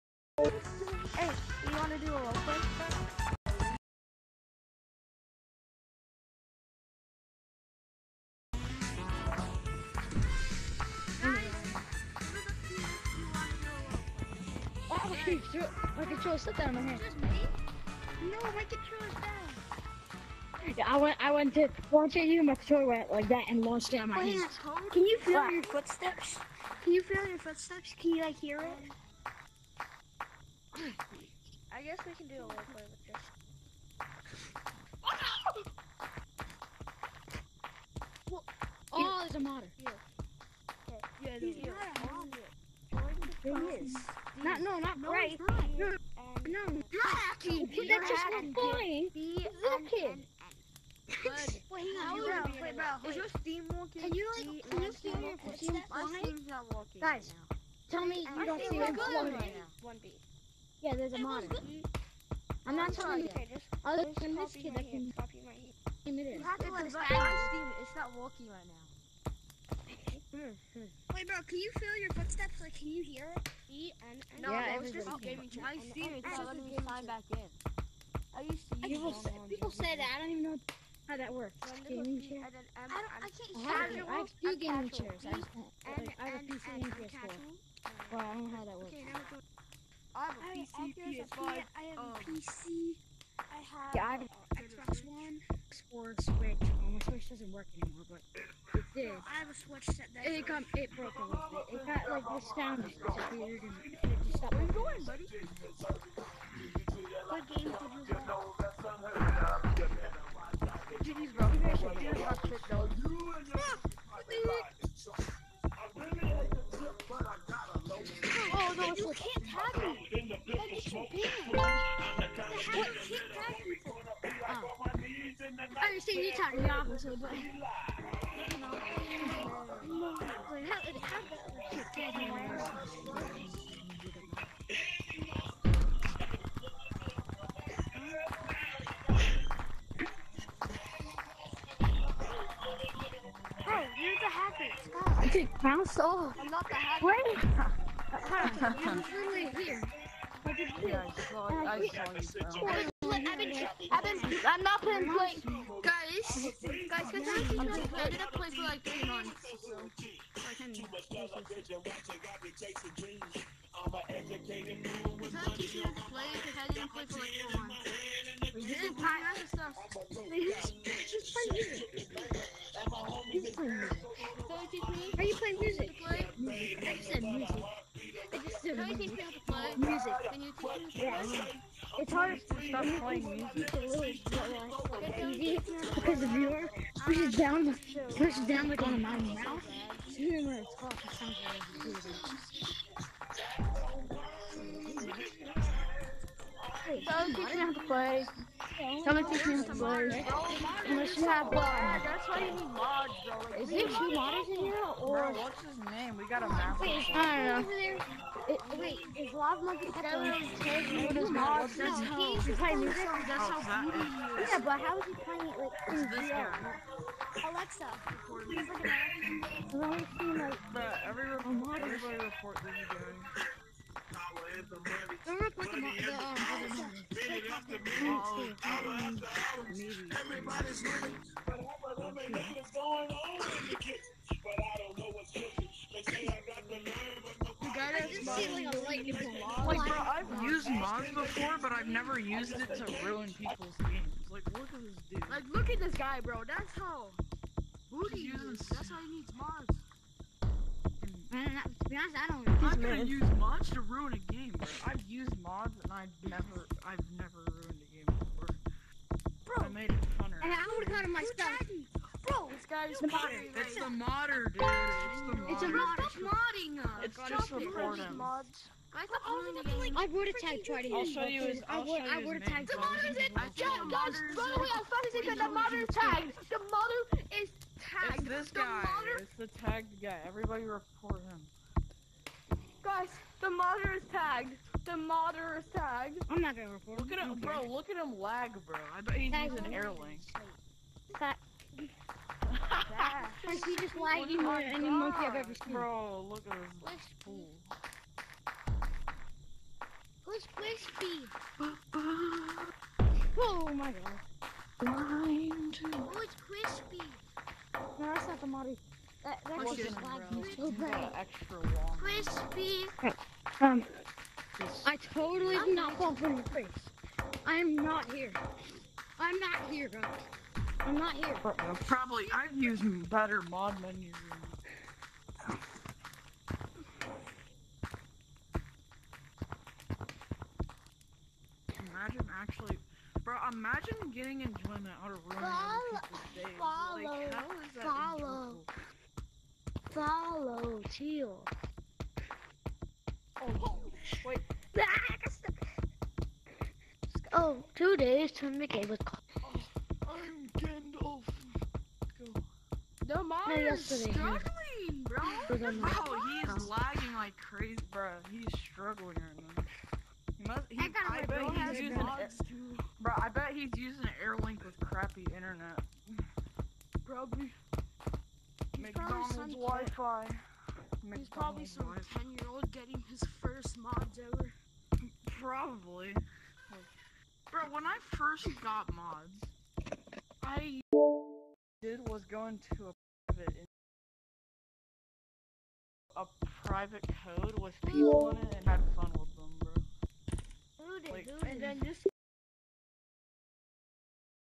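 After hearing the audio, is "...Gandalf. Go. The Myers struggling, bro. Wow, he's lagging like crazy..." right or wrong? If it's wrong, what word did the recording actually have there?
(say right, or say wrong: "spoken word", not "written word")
right.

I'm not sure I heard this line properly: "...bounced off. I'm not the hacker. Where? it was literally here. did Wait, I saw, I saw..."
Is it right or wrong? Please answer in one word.
wrong.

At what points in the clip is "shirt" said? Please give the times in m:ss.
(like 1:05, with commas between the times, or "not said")
not said.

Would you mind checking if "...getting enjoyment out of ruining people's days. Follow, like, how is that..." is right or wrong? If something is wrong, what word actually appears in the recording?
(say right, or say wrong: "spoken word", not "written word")
right.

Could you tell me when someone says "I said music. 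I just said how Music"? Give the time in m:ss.
2:56.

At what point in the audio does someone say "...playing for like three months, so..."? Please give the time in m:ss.
2:38.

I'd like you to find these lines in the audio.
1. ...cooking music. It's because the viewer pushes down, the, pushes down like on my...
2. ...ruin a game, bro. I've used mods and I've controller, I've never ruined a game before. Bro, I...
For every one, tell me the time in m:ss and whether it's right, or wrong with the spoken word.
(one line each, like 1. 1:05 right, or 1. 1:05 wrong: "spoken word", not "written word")
1. 3:02 wrong: "playing", not "cooking"
2. 4:13 wrong: "never", not "controller".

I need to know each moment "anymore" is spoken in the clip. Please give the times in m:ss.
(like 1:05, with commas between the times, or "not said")
1:37.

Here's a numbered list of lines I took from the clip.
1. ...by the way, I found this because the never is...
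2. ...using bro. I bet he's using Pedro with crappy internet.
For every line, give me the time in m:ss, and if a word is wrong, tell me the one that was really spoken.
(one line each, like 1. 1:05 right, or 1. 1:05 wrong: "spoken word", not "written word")
1. 4:34 wrong: "mother", not "never"
2. 6:01 wrong: "AirLink", not "Pedro".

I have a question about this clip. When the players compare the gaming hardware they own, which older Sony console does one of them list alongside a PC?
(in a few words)
PS4.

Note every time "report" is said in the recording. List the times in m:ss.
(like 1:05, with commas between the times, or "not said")
3:41, 4:40, 4:46.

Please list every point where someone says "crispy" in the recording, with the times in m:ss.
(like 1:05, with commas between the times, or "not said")
5:00, 5:06, 5:11.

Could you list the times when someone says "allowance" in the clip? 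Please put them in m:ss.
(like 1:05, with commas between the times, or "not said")
not said.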